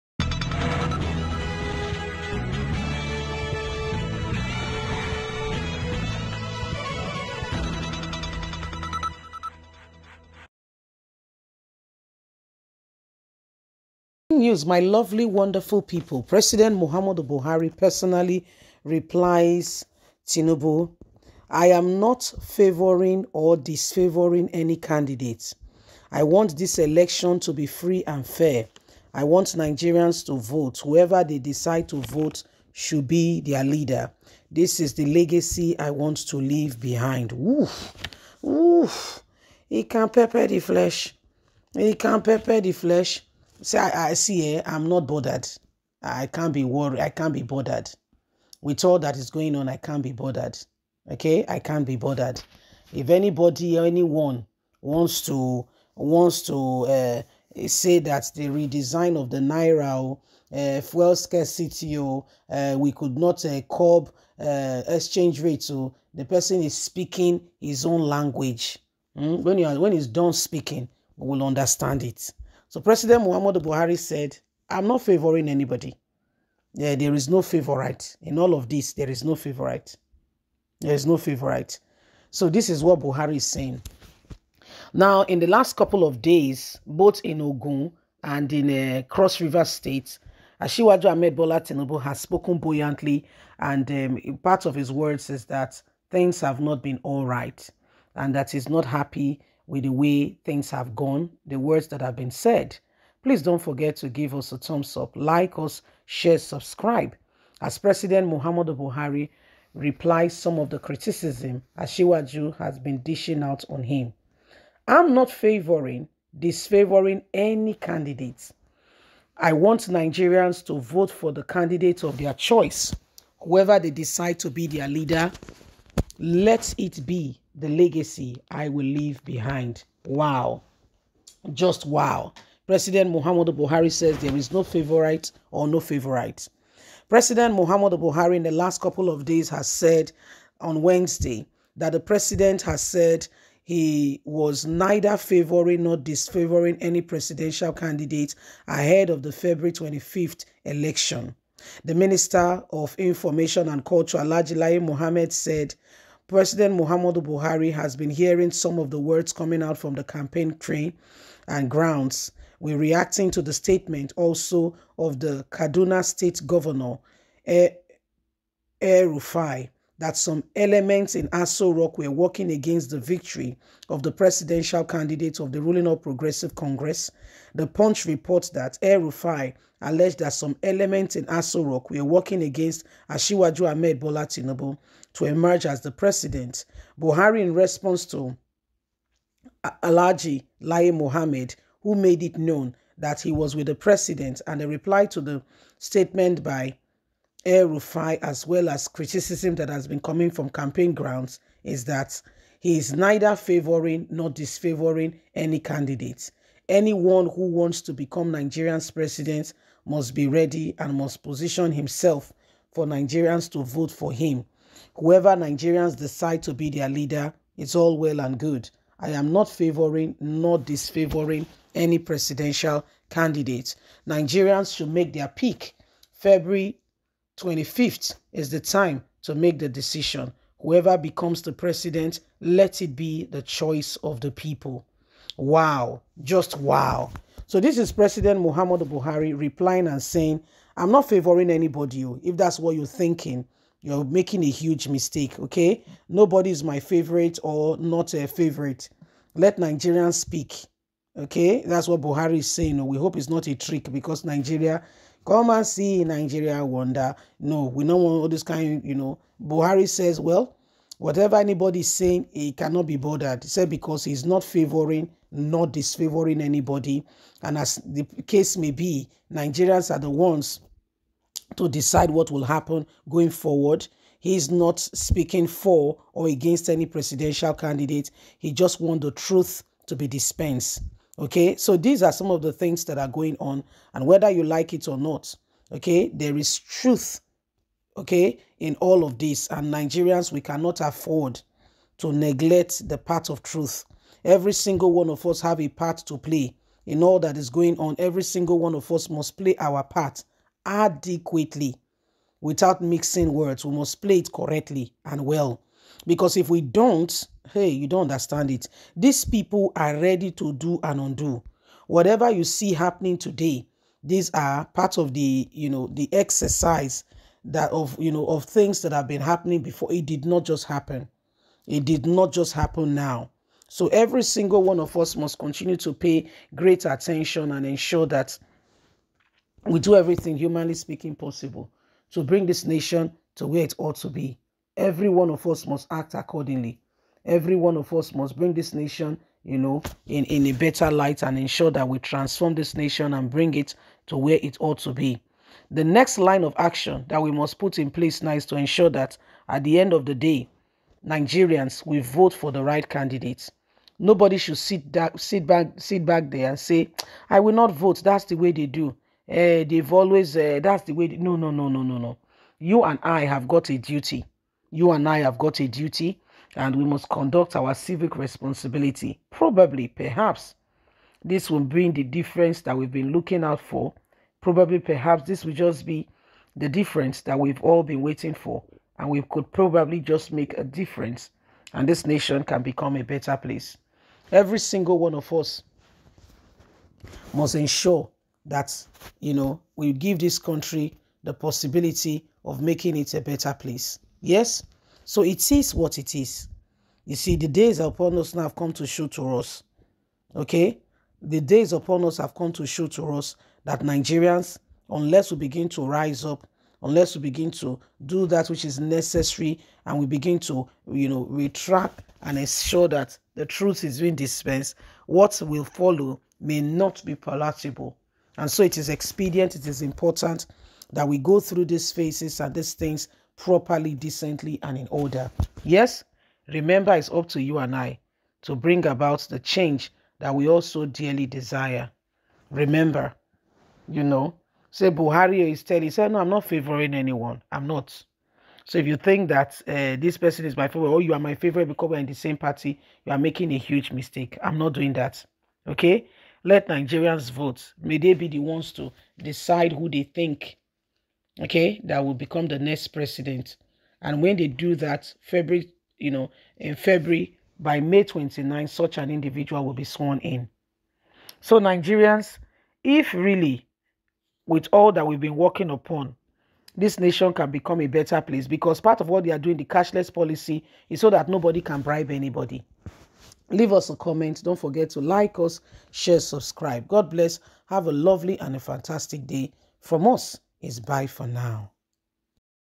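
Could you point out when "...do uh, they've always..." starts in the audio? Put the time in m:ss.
5:58.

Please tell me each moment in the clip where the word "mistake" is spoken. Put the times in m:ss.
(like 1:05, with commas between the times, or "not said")
4:04, 7:23.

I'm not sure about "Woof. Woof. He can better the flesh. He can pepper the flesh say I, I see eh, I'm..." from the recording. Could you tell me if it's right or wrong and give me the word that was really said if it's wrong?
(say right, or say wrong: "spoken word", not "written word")
wrong: "pepper", not "better".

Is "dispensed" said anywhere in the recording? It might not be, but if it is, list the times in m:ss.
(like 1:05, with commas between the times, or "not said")
4:40, 6:54.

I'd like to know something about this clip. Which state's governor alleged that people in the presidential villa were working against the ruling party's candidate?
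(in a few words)
Kaduna.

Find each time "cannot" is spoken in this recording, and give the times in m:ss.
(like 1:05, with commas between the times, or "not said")
4:22, 4:50.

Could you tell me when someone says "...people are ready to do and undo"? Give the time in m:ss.
5:09.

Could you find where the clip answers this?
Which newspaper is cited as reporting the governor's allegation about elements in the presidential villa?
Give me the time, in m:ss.
2:57.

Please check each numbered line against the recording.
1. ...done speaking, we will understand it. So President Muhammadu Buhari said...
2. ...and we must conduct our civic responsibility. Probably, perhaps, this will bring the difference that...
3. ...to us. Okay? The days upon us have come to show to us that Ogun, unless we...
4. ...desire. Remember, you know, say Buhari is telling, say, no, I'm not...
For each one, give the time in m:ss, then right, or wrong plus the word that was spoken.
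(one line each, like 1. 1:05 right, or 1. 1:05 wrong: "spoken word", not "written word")
1. 1:10 right
2. 6:06 right
3. 6:39 wrong: "Nigerians", not "Ogun"
4. 7:11 right.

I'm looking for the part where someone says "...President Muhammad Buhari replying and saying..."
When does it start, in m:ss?
3:57.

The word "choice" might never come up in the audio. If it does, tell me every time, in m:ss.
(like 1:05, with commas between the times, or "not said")
2:02, 3:53.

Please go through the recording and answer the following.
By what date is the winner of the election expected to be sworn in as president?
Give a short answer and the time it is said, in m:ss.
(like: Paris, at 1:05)
May 29, at 7:37.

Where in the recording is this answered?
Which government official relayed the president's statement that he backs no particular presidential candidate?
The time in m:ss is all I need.
3:10.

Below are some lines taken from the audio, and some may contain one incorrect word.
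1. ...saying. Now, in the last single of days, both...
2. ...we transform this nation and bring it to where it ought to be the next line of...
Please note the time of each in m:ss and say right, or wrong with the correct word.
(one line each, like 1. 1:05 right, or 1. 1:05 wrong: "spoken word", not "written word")
1. 1:23 wrong: "couple", not "single"
2. 5:41 right.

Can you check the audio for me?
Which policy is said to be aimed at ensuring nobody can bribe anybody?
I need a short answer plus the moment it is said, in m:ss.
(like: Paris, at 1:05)
cashless policy, at 7:49.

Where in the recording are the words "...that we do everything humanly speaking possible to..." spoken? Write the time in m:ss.
5:28.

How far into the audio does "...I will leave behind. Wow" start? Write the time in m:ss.
2:08.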